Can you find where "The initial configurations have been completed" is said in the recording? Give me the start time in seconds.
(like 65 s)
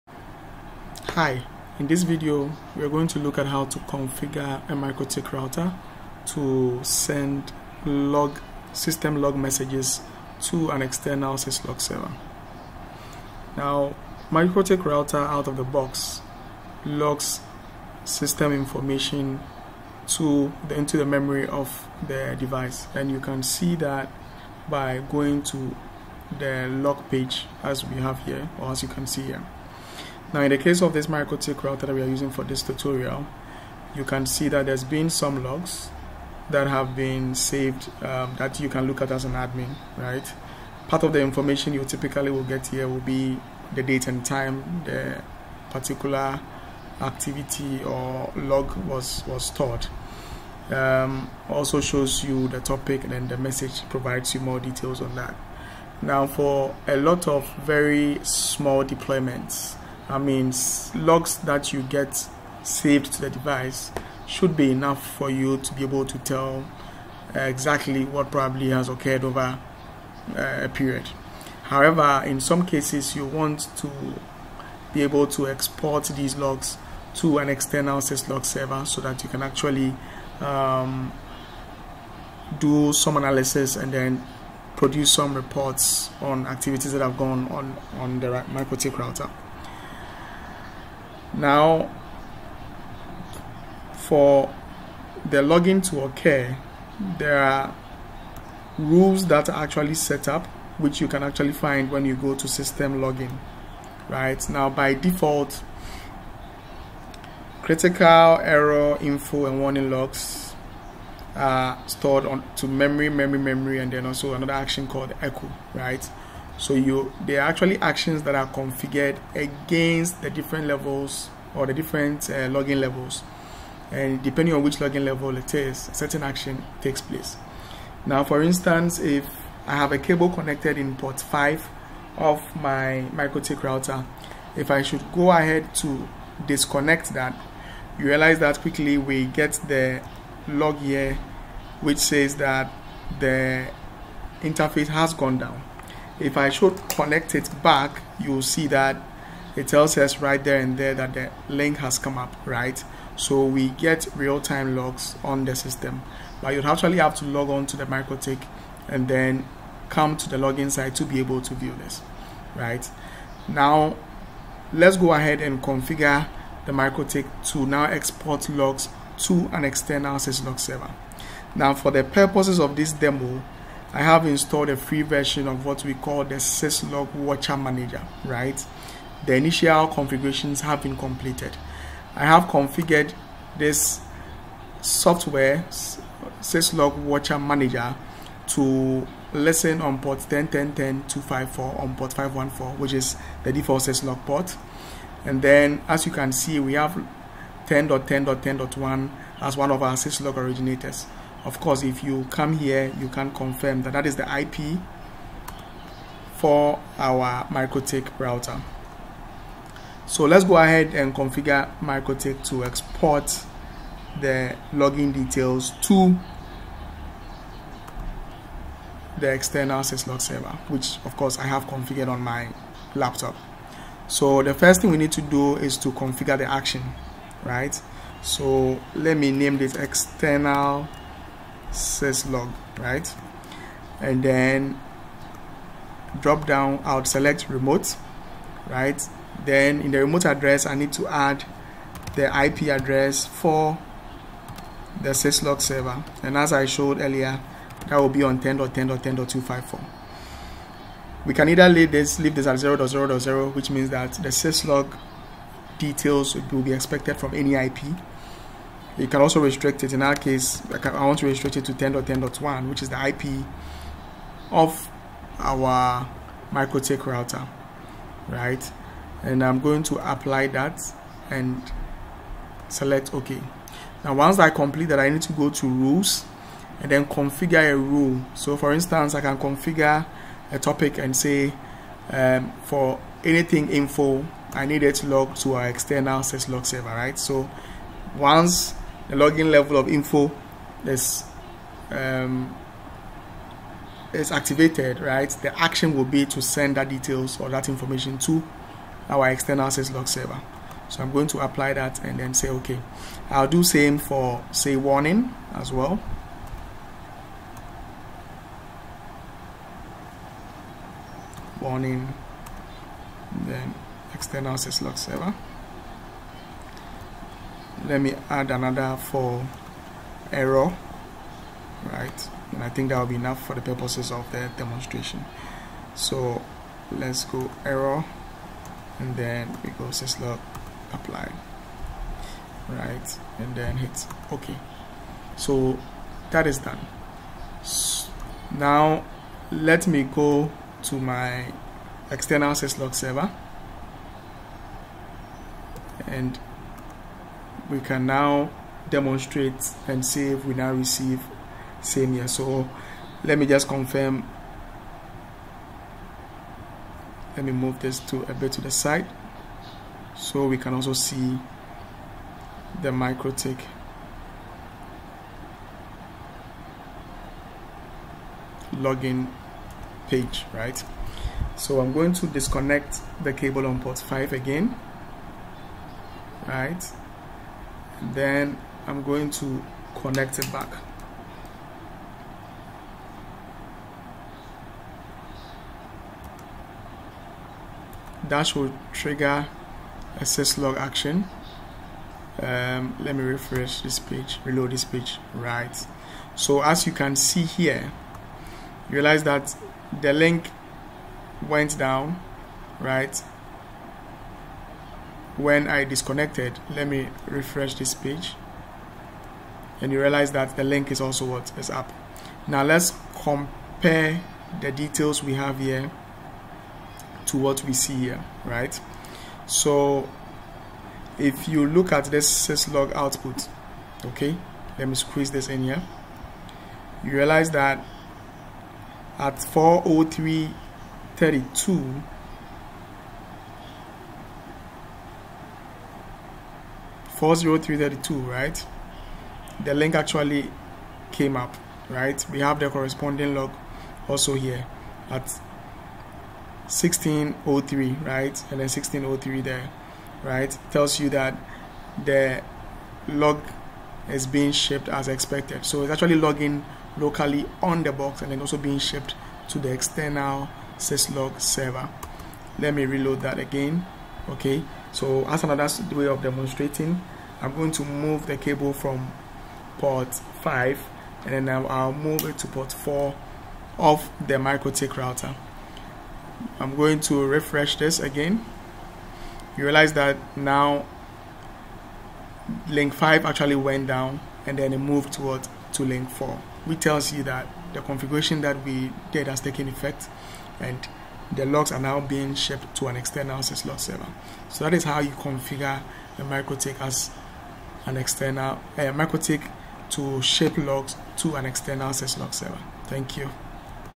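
179 s.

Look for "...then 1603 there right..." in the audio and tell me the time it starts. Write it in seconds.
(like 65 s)
448 s.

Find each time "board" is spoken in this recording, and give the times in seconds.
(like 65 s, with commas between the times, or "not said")
not said.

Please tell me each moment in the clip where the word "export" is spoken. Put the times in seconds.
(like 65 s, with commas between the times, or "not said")
75 s, 167 s, 212 s.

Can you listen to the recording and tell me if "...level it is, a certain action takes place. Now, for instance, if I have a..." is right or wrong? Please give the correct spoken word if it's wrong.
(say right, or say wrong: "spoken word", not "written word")
right.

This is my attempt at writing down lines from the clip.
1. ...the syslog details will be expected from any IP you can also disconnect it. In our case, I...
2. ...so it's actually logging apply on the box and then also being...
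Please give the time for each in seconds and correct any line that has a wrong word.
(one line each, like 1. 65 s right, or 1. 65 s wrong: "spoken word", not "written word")
1. 254 s wrong: "restrict", not "disconnect"
2. 455 s wrong: "locally", not "apply".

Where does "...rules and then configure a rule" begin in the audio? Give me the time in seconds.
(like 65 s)
275 s.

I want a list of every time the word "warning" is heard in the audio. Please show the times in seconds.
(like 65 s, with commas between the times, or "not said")
109 s, 304 s, 311 s.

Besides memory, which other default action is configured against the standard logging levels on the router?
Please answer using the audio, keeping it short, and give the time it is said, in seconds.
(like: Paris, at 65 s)
echo, at 115 s.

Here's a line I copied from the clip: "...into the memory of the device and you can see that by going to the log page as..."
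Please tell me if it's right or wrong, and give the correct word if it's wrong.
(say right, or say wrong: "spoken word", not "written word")
right.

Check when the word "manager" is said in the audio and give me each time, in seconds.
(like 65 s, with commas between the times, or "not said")
177 s, 187 s.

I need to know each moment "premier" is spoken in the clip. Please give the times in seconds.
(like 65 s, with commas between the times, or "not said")
not said.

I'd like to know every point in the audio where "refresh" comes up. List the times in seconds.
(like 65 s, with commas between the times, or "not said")
393 s, 407 s, 477 s.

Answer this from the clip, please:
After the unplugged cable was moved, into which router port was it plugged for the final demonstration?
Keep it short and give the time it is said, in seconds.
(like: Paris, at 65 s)
port 4, at 472 s.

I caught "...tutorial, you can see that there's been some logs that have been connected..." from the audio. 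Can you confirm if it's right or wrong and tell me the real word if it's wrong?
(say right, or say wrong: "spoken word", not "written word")
wrong: "saved", not "connected".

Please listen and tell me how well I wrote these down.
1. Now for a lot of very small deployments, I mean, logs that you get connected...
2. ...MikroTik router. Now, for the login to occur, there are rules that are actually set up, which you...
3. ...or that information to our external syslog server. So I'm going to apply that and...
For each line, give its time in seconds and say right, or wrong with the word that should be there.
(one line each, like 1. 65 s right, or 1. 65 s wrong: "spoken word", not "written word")
1. 56 s wrong: "saved", not "connected"
2. 88 s right
3. 297 s right.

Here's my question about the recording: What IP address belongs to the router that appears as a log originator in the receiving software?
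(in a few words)
10.10.10.1.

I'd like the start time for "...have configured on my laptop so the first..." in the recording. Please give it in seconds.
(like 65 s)
221 s.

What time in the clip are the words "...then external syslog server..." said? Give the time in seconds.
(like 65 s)
313 s.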